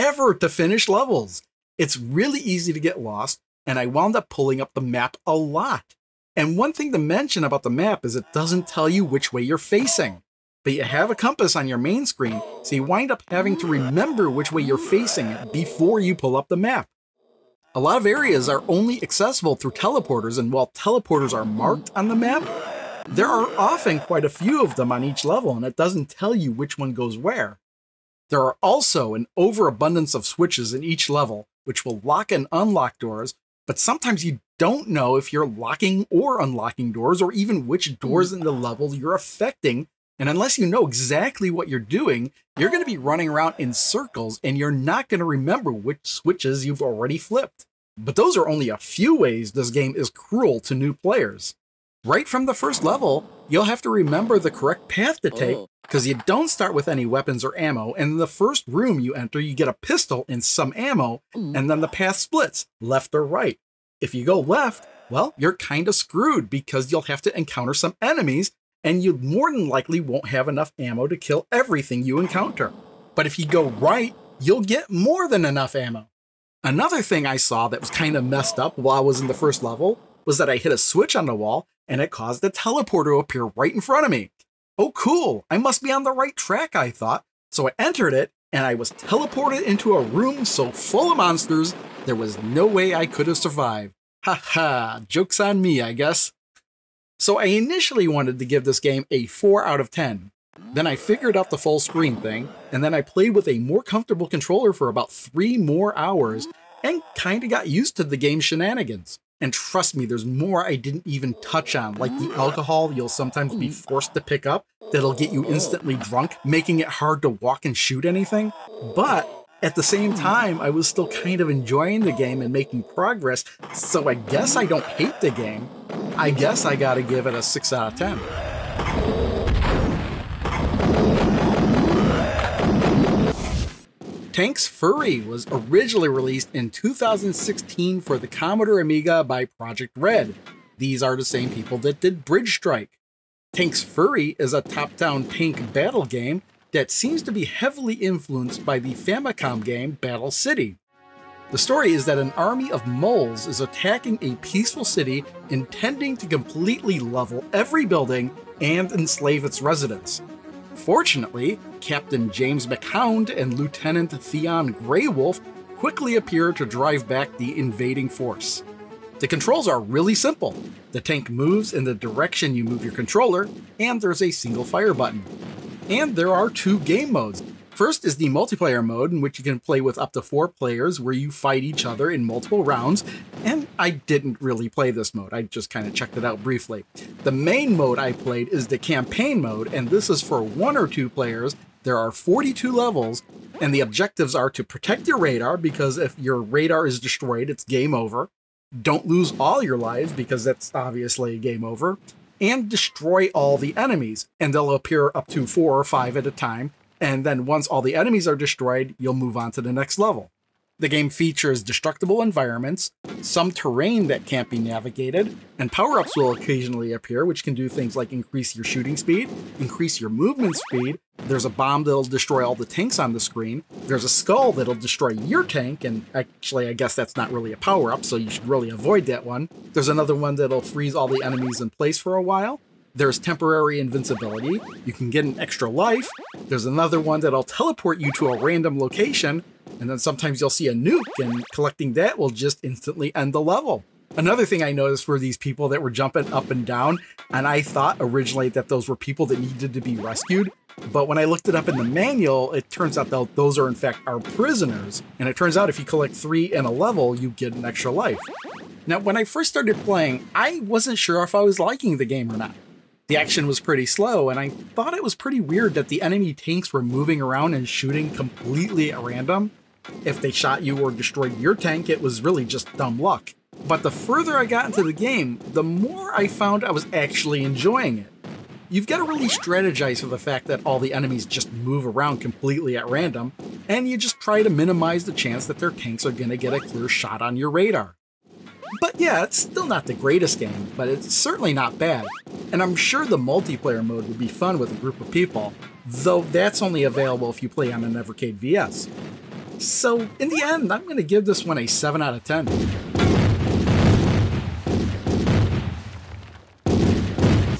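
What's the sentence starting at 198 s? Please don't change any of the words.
Don't lose all your lives, because that's obviously game over.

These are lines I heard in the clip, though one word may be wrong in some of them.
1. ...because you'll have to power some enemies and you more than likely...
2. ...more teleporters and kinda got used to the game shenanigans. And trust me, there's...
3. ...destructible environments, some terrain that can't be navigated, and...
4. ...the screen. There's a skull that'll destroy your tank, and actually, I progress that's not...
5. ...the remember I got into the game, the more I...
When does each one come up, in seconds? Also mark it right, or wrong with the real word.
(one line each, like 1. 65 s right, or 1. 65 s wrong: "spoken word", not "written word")
1. 66 s wrong: "encounter", not "power"
2. 105 s wrong: "hours", not "teleporters"
3. 211 s right
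4. 223 s wrong: "guess", not "progress"
5. 273 s wrong: "further", not "remember".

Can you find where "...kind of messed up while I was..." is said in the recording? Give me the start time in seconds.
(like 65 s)
77 s.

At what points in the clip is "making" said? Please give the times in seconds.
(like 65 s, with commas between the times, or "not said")
116 s, 122 s.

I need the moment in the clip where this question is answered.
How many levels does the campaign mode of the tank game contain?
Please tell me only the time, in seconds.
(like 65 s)
192 s.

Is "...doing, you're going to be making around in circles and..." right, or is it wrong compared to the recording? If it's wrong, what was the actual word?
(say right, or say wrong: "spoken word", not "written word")
wrong: "running", not "making".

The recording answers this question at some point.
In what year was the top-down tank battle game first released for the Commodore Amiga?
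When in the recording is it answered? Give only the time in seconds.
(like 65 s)
136 s.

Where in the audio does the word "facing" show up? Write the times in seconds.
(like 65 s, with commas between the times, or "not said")
9 s, 14 s.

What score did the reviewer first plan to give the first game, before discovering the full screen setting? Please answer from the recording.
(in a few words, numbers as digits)
4 out of 10.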